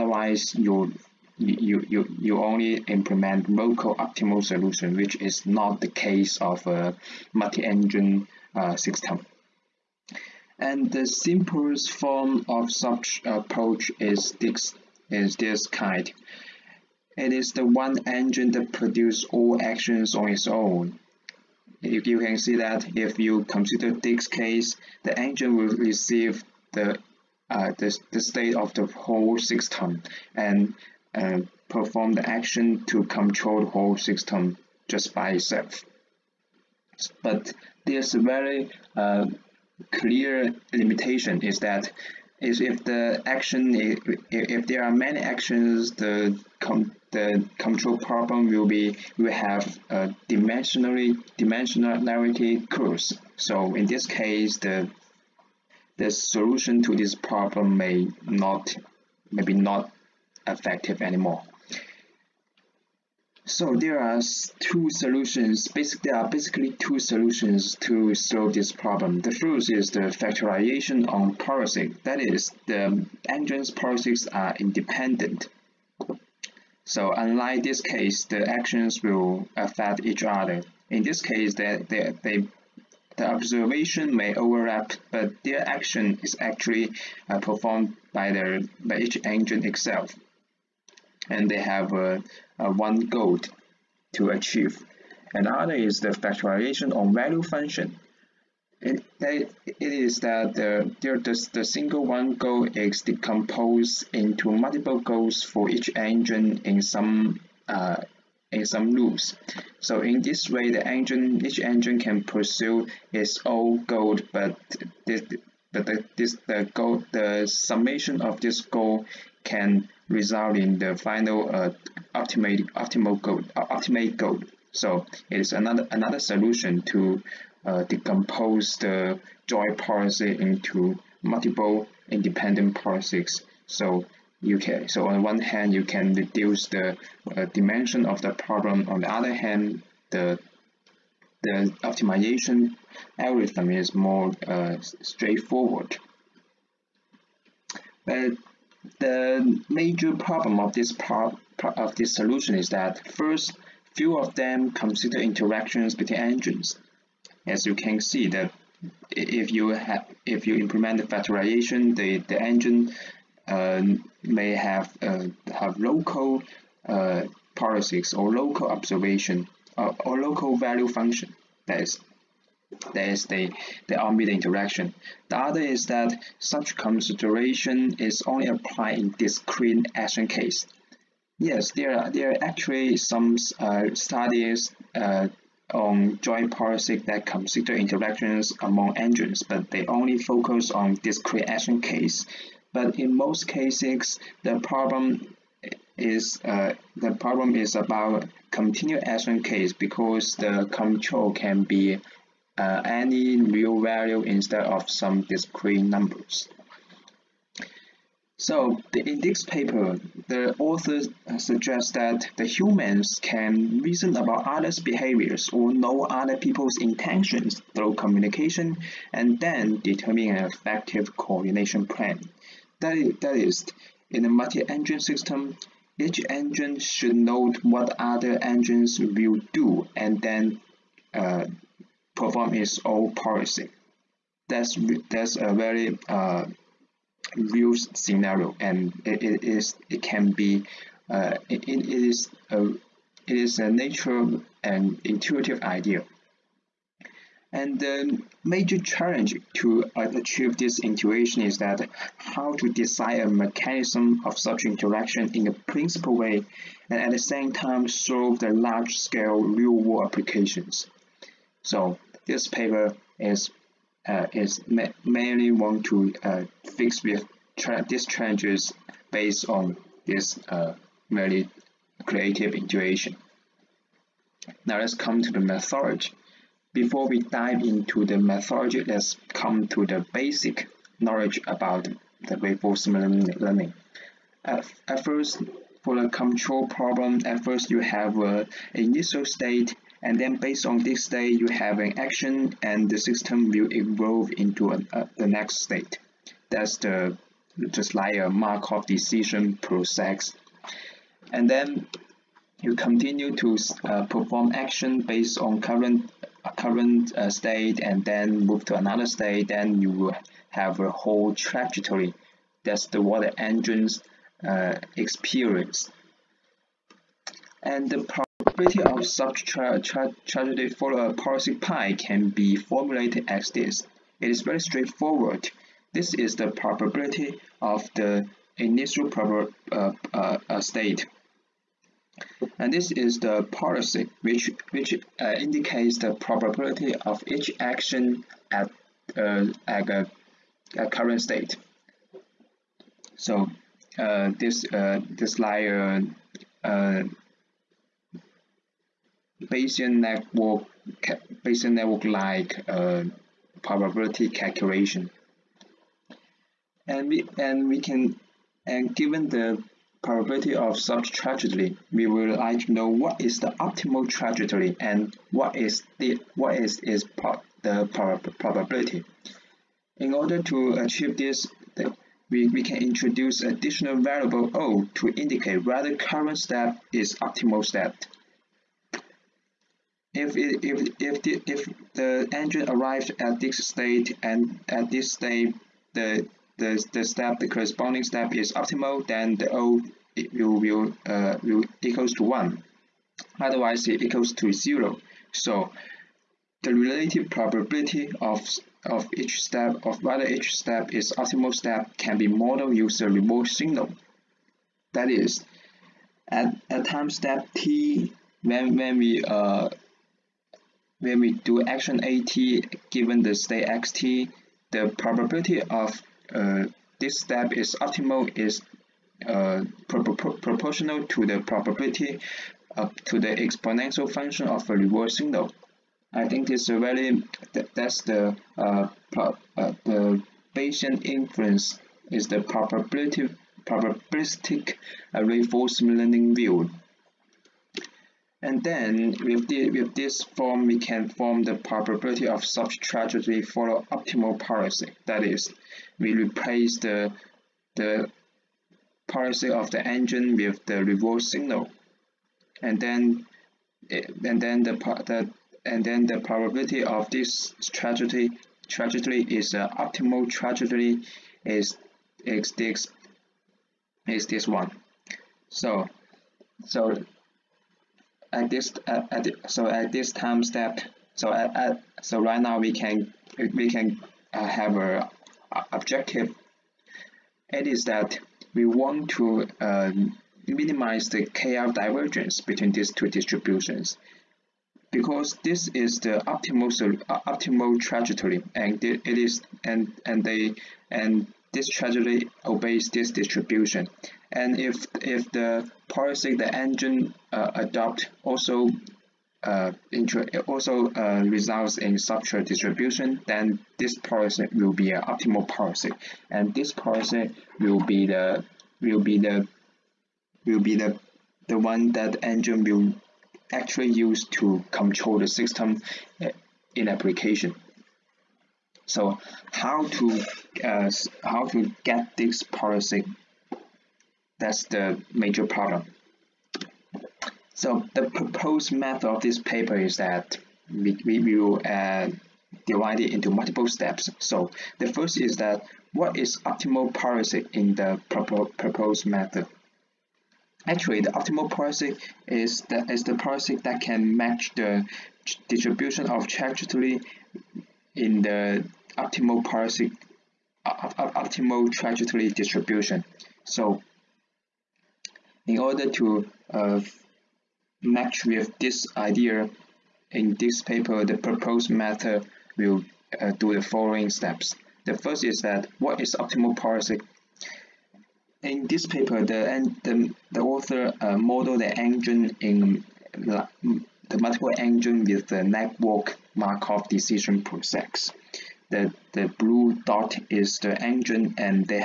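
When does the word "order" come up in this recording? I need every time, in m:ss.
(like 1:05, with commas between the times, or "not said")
6:10, 9:15.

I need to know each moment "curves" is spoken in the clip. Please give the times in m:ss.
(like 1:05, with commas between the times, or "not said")
0:52.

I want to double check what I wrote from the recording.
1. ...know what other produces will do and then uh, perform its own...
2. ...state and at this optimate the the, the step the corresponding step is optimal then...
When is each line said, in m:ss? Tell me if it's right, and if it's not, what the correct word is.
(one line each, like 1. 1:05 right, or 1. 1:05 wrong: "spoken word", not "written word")
1. 3:47 wrong: "engines", not "produces"
2. 6:23 wrong: "state", not "optimate".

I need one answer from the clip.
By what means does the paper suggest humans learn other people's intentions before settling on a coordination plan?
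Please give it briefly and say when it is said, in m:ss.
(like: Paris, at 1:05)
communication, at 3:37.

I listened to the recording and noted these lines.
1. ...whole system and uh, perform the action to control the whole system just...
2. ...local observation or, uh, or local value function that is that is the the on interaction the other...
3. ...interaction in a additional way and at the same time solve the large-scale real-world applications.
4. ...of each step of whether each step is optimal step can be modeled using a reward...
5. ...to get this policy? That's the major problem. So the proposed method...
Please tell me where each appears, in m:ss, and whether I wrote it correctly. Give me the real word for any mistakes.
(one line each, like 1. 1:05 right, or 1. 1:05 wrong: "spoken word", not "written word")
1. 0:28 right
2. 2:48 right
3. 4:14 wrong: "principal", not "additional"
4. 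6:38 right
5. 8:41 right.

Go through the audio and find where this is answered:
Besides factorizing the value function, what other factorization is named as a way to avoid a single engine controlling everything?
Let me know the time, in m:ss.
1:10.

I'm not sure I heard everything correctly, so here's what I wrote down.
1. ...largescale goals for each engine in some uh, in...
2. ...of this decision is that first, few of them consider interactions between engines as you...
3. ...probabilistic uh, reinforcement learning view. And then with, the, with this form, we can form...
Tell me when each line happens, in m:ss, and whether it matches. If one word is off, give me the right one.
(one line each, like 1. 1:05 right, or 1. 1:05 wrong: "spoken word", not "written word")
1. 1:44 wrong: "multiple", not "largescale"
2. 2:31 wrong: "solution", not "decision"
3. 7:13 right.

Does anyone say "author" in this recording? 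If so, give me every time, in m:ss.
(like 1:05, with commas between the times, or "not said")
3:30, 9:30.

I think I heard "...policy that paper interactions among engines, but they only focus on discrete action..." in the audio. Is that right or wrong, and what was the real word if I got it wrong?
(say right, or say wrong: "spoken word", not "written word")
wrong: "consider", not "paper".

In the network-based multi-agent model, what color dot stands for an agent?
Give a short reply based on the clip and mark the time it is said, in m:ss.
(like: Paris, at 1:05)
blue, at 9:39.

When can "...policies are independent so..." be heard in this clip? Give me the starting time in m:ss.
1:13.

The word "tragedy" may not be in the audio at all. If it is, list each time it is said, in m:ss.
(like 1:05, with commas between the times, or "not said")
5:20, 8:11.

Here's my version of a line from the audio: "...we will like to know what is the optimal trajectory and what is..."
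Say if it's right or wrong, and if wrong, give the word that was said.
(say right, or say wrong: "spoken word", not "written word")
right.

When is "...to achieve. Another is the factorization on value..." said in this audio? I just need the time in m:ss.
1:34.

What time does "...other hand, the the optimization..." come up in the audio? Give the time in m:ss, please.
2:19.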